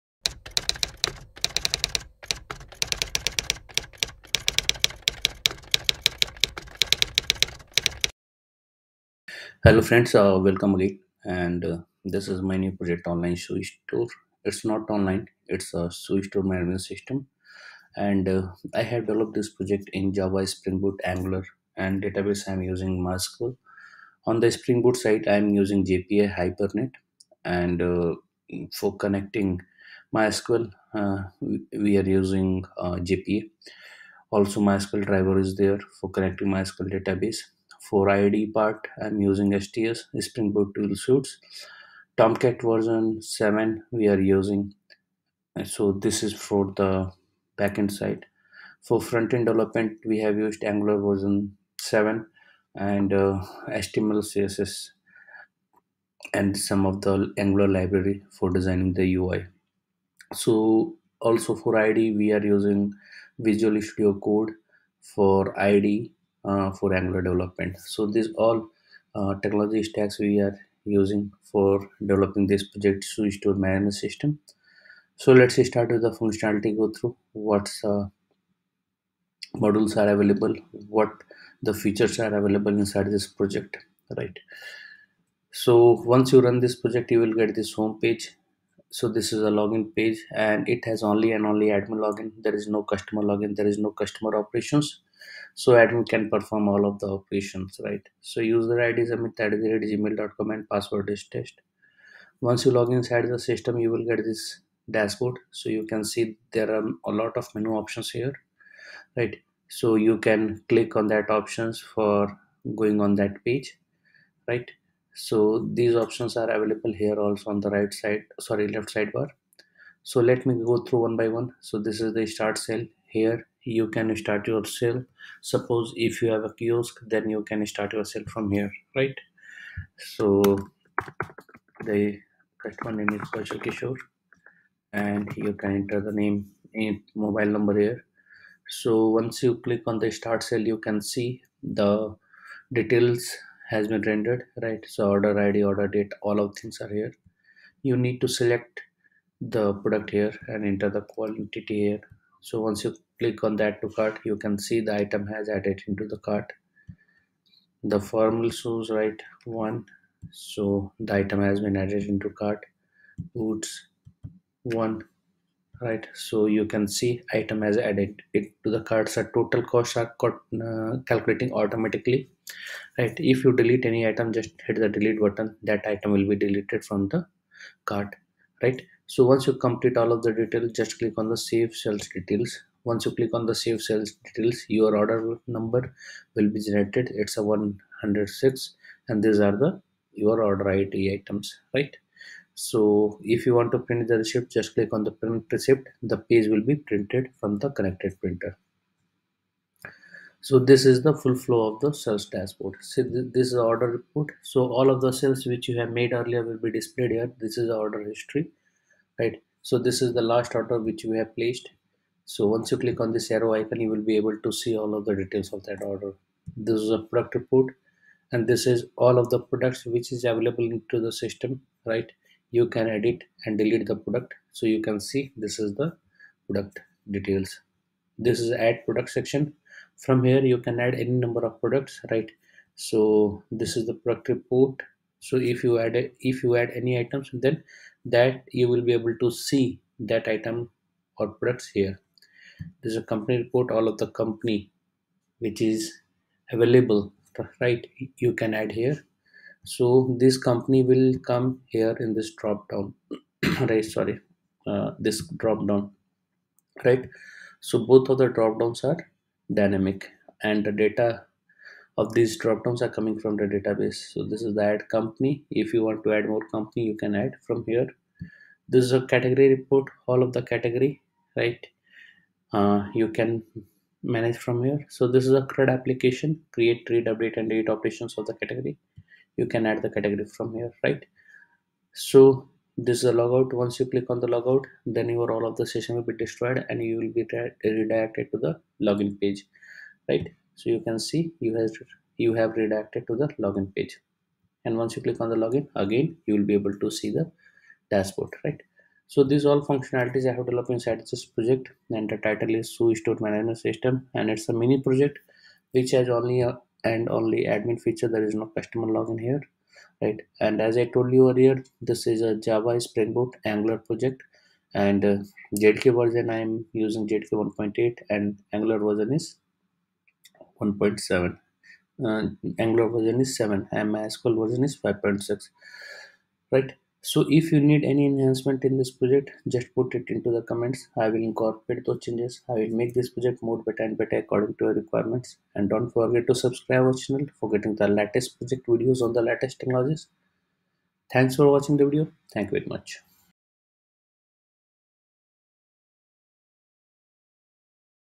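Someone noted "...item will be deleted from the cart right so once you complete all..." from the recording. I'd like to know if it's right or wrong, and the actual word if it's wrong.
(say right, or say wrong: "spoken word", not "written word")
right.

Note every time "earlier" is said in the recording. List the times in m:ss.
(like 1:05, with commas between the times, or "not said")
3:26, 5:11.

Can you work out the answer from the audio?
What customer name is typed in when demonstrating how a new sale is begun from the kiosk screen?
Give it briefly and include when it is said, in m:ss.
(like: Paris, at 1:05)
Kaushal Kishore, at 2:13.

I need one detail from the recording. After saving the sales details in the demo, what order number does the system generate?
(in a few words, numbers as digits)
106.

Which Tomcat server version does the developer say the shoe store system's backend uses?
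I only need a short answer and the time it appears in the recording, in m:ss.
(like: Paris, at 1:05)
7, at 0:42.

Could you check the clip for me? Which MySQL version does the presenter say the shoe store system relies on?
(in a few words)
5.6.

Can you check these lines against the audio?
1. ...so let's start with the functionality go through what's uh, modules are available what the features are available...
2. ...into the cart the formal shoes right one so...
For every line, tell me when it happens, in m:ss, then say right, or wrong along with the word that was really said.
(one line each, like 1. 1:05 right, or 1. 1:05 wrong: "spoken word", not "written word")
1. 1:15 right
2. 2:35 right.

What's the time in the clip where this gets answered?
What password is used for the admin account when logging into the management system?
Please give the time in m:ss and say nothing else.
1:40.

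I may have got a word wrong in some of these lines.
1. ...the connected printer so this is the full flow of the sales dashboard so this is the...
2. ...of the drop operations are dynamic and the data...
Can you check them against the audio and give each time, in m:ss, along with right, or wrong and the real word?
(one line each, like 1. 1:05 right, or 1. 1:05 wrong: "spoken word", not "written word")
1. 3:17 right
2. 4:18 wrong: "downs", not "operations".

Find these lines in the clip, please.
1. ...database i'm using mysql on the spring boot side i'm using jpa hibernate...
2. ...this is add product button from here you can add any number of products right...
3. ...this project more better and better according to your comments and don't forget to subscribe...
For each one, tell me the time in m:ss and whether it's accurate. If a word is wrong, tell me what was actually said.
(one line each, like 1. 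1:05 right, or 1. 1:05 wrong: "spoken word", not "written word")
1. 0:22 right
2. 3:48 wrong: "section", not "button"
3. 5:32 wrong: "requirements", not "comments".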